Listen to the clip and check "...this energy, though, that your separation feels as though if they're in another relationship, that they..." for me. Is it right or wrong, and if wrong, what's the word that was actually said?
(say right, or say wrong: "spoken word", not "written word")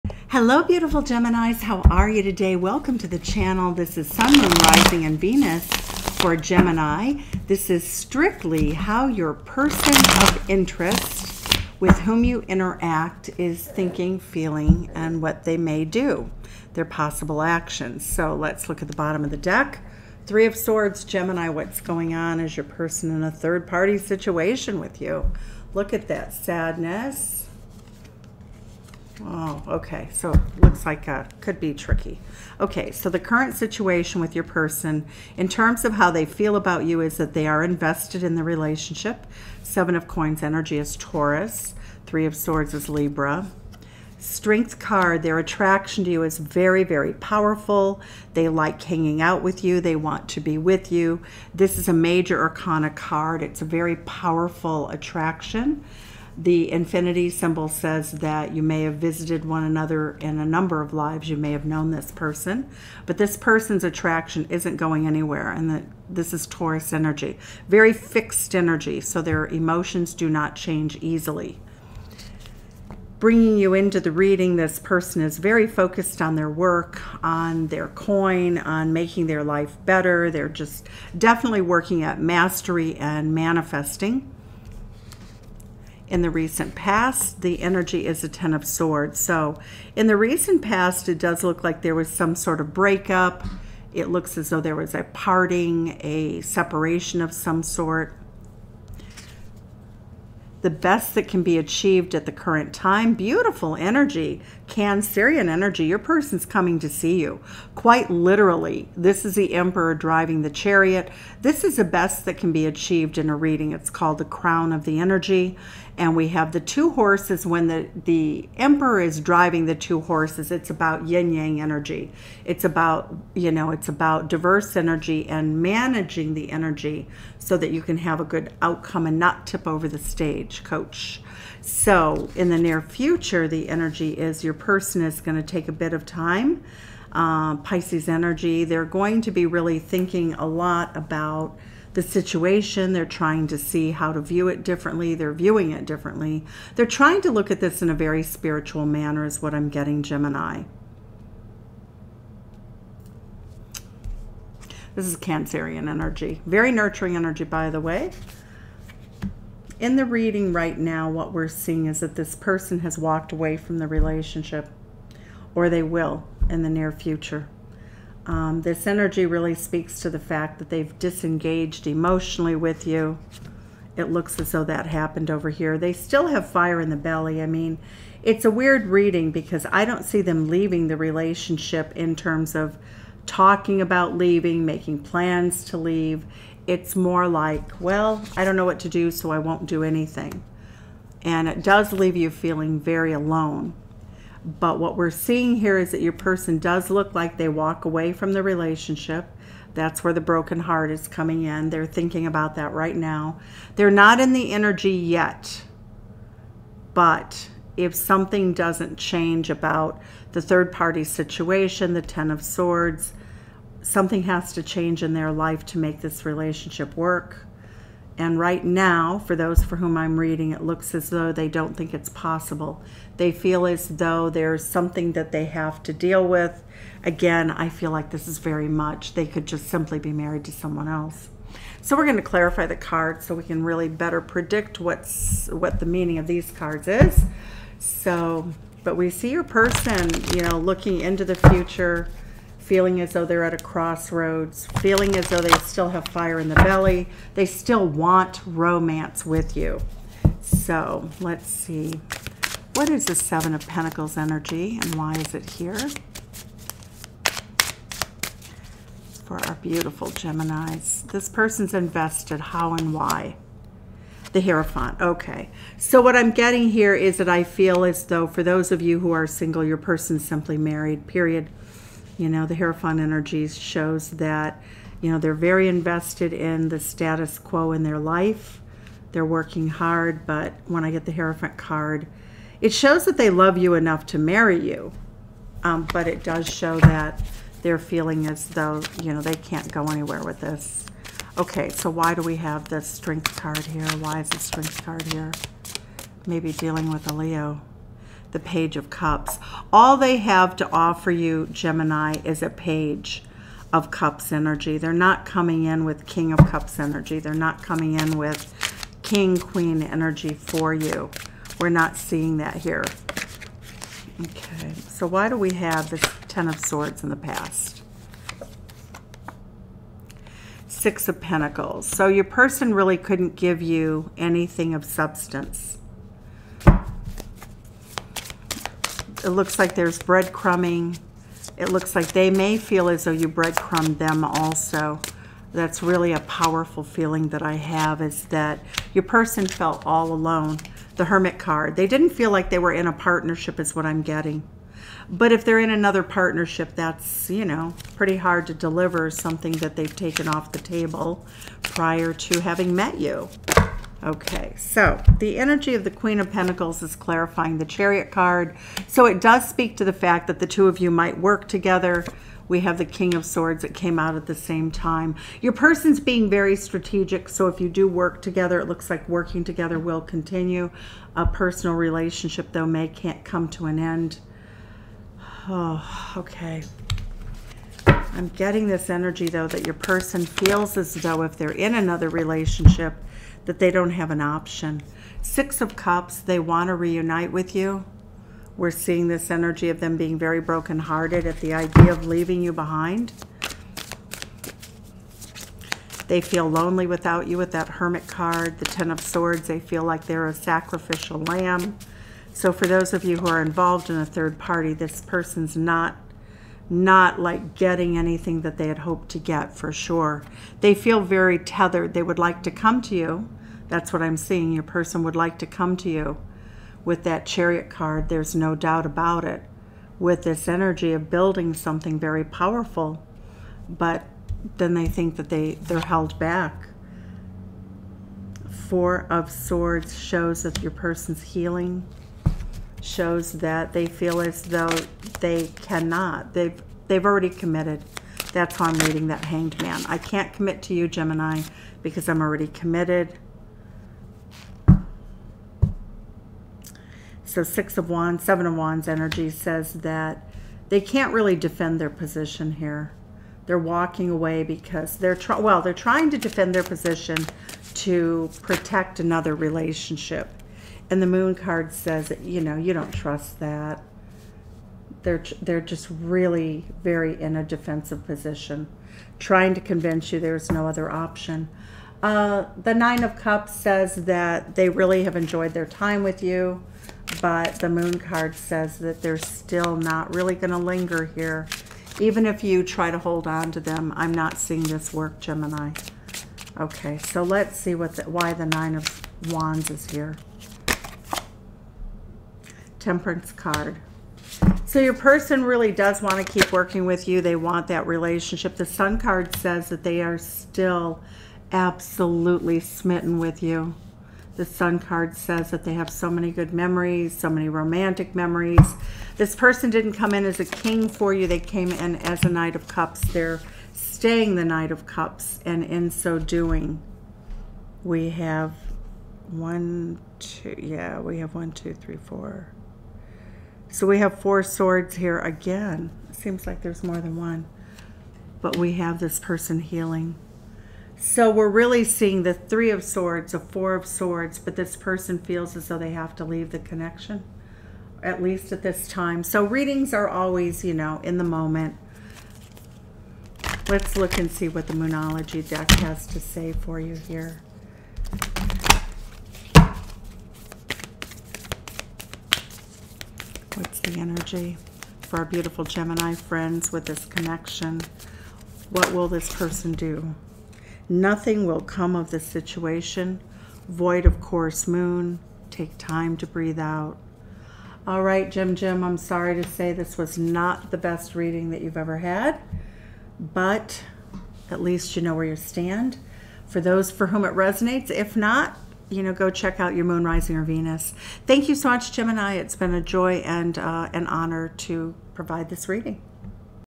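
wrong: "person", not "separation".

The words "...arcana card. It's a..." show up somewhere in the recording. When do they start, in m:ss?
0:52.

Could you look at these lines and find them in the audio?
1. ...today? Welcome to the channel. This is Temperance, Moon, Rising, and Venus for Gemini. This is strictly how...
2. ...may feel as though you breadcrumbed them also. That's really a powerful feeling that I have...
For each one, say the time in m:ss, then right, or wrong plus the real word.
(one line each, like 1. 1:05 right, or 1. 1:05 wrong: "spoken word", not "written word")
1. 0:02 wrong: "Sun", not "Temperance"
2. 5:32 right.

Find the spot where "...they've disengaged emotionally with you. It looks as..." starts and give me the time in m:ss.
2:50.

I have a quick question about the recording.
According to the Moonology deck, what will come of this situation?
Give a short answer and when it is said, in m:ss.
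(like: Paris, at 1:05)
Void of course moon, at 9:23.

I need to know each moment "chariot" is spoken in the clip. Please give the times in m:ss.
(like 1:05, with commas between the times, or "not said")
1:50, 5:57, 6:57.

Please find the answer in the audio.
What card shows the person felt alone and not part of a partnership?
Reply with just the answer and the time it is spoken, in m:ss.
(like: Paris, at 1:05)
The Hermit, at 5:40.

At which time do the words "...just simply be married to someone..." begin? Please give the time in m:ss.
3:49.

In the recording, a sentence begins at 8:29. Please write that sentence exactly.
This person didn't come in as a king for you.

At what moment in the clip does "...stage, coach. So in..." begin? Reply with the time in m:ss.
2:09.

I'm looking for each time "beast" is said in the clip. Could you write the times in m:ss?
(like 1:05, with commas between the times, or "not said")
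not said.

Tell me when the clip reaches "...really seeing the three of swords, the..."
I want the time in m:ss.
8:51.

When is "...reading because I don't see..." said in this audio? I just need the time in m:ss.
2:58.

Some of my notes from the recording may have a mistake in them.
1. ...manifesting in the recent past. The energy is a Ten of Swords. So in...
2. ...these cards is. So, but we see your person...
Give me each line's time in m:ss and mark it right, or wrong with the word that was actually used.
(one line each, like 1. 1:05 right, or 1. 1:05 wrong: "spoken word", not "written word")
1. 1:23 right
2. 3:56 right.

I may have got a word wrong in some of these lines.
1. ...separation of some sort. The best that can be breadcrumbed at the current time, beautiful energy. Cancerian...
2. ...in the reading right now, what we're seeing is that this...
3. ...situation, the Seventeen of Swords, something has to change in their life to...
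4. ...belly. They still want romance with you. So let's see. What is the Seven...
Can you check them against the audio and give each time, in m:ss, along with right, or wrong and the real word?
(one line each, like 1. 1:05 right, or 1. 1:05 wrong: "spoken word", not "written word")
1. 1:36 wrong: "achieved", not "breadcrumbed"
2. 2:39 right
3. 3:31 wrong: "Ten", not "Seventeen"
4. 4:06 right.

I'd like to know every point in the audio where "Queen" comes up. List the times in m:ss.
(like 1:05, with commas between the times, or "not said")
5:09, 5:55.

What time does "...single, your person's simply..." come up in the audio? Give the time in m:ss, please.
4:29.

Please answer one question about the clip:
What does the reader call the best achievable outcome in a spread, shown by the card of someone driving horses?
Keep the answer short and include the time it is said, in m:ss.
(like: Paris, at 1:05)
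The crown, at 1:54.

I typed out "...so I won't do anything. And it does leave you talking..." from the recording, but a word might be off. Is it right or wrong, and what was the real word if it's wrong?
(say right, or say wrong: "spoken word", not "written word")
wrong: "feeling", not "talking".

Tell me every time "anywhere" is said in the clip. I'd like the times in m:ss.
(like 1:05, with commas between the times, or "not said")
1:05, 4:49.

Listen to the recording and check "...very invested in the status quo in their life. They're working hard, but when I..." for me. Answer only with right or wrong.
right.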